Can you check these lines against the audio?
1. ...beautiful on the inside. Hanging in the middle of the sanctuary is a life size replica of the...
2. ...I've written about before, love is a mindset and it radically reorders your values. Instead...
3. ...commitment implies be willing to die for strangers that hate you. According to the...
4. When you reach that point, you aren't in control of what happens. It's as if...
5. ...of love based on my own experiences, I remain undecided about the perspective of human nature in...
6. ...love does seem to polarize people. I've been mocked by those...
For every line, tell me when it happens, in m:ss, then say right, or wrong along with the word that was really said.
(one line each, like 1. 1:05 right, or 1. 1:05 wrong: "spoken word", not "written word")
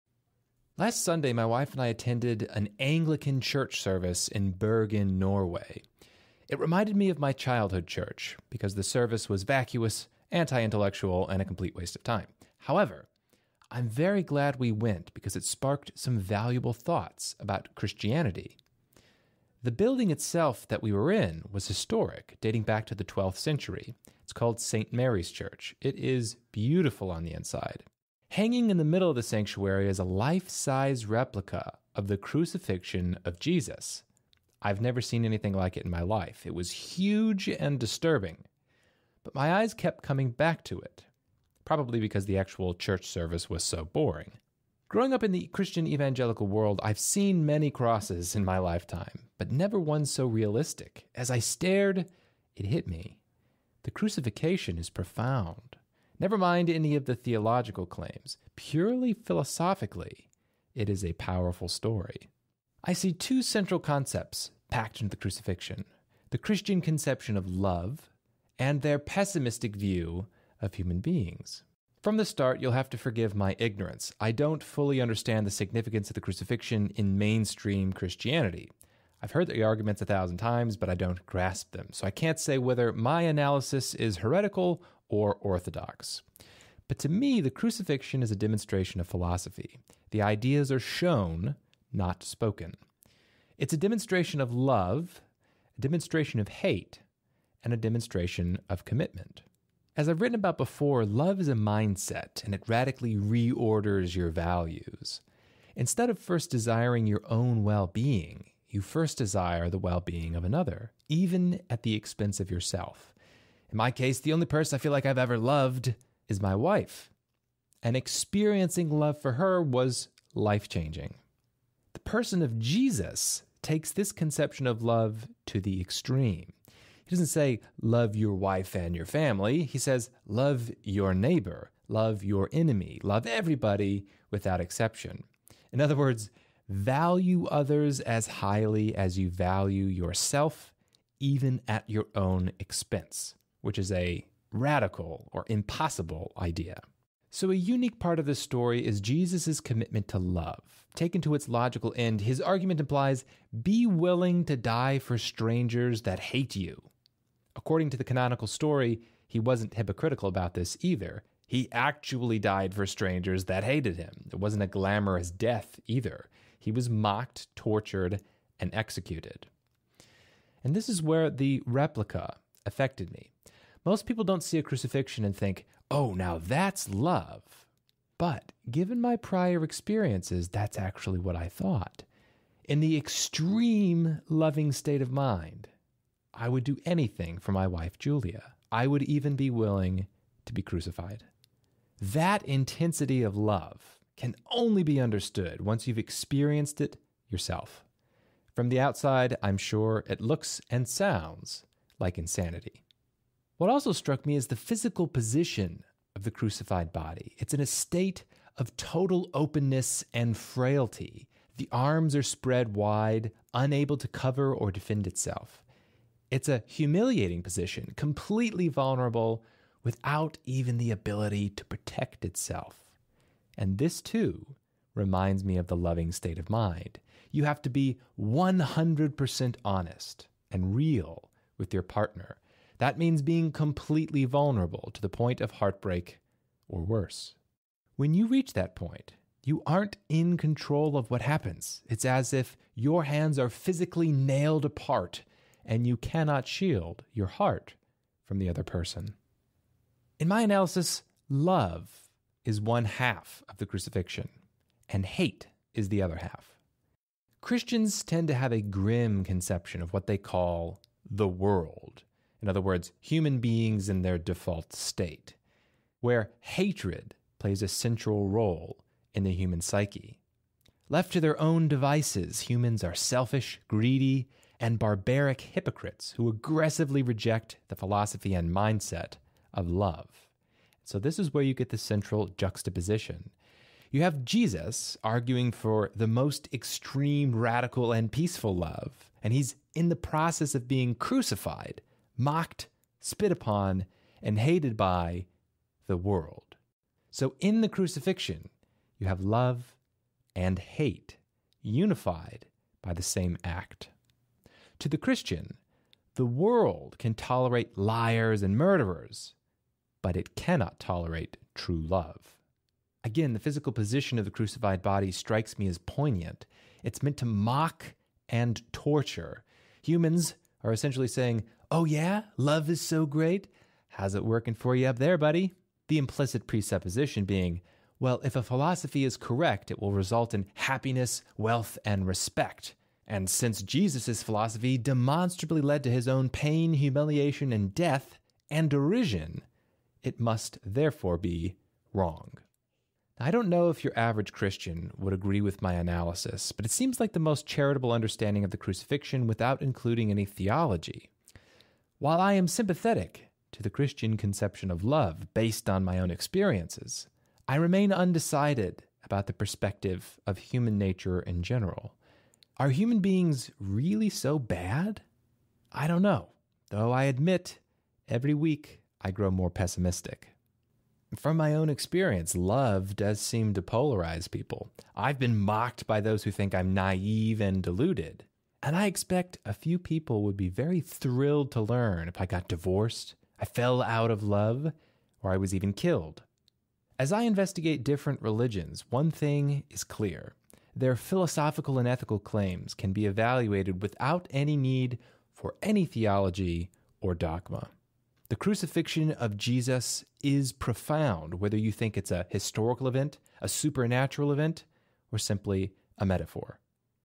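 1. 0:26 right
2. 1:40 right
3. 2:32 wrong: "argument", not "commitment"
4. 3:57 right
5. 5:54 right
6. 6:12 right.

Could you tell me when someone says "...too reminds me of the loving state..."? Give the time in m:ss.
3:44.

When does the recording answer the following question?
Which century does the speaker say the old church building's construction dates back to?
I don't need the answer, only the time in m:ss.
0:23.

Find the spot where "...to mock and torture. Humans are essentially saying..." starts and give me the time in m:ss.
5:17.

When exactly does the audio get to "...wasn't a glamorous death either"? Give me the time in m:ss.
2:44.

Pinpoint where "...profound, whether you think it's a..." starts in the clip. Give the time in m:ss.
6:40.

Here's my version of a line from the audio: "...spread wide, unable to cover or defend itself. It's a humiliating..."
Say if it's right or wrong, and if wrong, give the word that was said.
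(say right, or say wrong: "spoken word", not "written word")
right.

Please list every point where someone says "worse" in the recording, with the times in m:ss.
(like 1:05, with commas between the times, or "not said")
3:56.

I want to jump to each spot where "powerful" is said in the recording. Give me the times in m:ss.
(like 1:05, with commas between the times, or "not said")
1:01.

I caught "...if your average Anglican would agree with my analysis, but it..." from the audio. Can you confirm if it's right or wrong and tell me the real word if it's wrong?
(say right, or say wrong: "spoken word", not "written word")
wrong: "Christian", not "Anglican".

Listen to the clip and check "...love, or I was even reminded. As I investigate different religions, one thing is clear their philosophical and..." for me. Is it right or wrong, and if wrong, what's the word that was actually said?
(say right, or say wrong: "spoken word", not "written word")
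wrong: "killed", not "reminded".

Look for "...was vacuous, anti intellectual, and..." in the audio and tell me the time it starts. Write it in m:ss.
0:09.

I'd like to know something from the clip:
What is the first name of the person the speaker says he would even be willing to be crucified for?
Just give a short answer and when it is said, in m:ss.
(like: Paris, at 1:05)
Julia, at 3:07.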